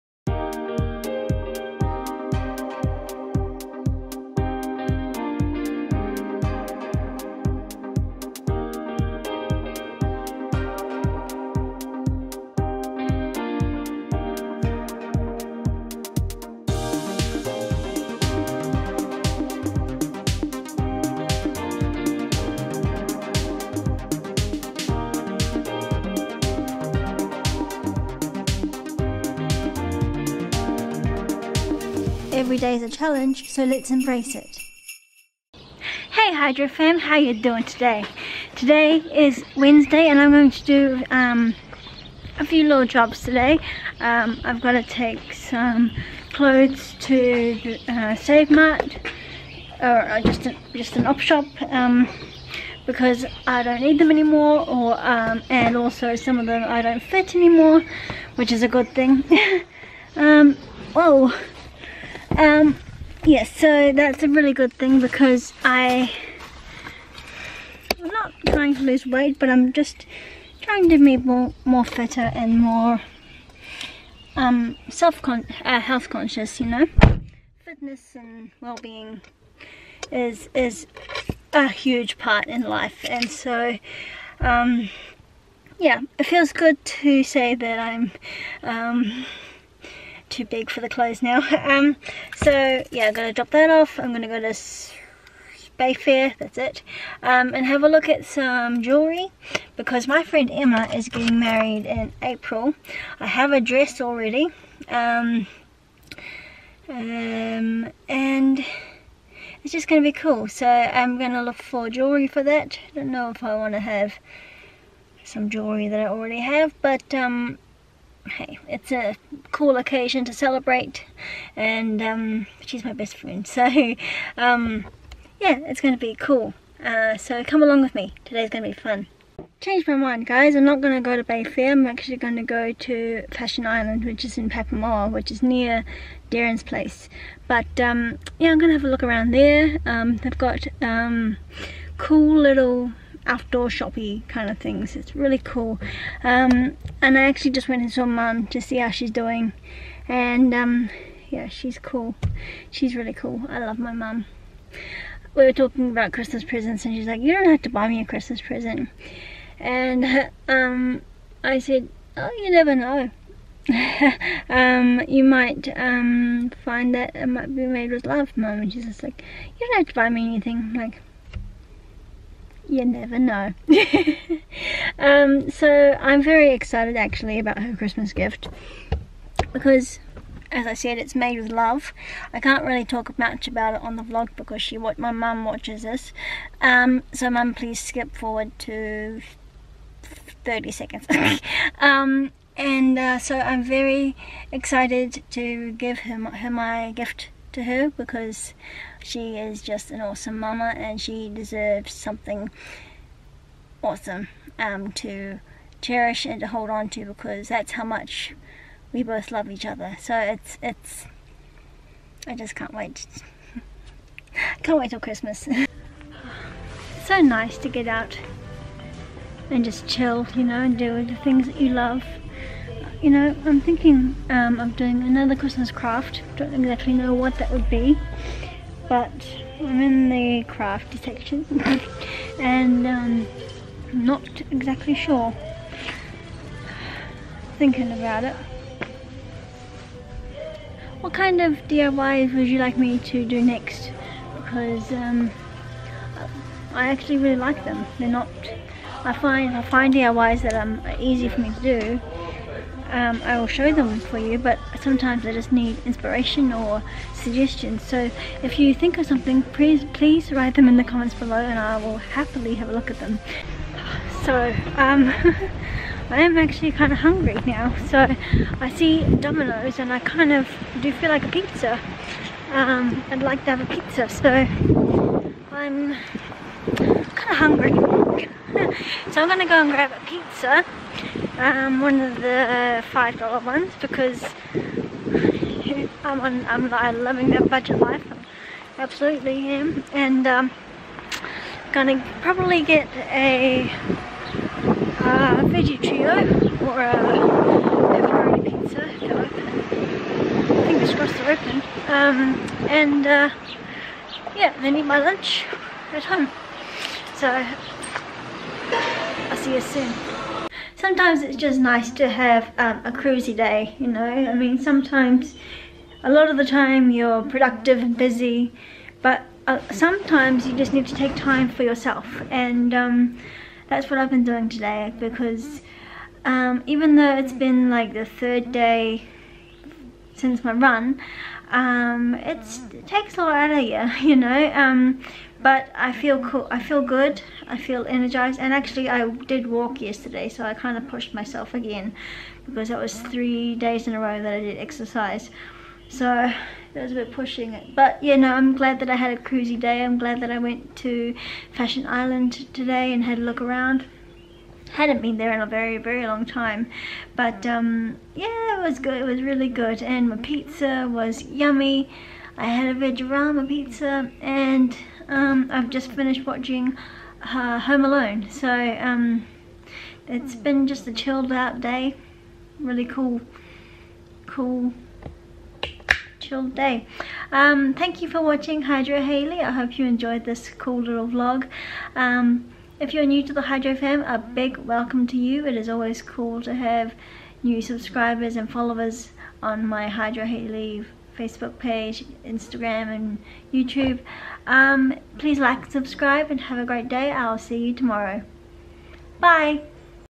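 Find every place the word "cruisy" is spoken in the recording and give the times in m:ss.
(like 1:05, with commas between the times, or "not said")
5:12, 5:49.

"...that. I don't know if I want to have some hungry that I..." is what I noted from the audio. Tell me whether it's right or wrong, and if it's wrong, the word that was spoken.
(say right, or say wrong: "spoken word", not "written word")
wrong: "jewellery", not "hungry".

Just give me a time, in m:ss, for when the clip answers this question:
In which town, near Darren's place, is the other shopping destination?
2:14.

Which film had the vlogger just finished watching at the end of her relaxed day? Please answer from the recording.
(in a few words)
Home Alone.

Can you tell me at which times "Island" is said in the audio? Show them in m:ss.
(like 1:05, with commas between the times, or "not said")
2:13, 5:51.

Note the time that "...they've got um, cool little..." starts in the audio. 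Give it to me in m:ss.
2:20.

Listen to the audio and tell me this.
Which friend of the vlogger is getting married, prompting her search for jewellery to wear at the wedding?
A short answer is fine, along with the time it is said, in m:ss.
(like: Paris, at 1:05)
Emma, at 1:40.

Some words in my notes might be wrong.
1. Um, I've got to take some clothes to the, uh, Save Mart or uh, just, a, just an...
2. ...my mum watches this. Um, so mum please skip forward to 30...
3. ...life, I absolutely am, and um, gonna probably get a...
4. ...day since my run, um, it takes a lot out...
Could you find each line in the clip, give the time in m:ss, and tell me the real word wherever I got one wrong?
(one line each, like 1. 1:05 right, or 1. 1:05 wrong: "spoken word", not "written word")
1. 0:43 right
2. 3:04 right
3. 4:47 right
4. 5:28 right.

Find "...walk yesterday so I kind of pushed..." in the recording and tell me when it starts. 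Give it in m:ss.
5:39.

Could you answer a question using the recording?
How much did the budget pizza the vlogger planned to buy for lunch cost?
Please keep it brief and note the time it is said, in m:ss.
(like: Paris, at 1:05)
$5, at 4:42.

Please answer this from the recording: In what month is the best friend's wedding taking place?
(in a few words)
April.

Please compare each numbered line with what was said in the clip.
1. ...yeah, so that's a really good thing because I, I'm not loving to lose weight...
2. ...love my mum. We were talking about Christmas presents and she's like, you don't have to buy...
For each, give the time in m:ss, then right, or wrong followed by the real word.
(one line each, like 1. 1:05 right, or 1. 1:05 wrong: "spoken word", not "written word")
1. 1:03 wrong: "trying", not "loving"
2. 2:33 right.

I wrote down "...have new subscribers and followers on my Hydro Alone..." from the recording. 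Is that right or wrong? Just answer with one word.
wrong.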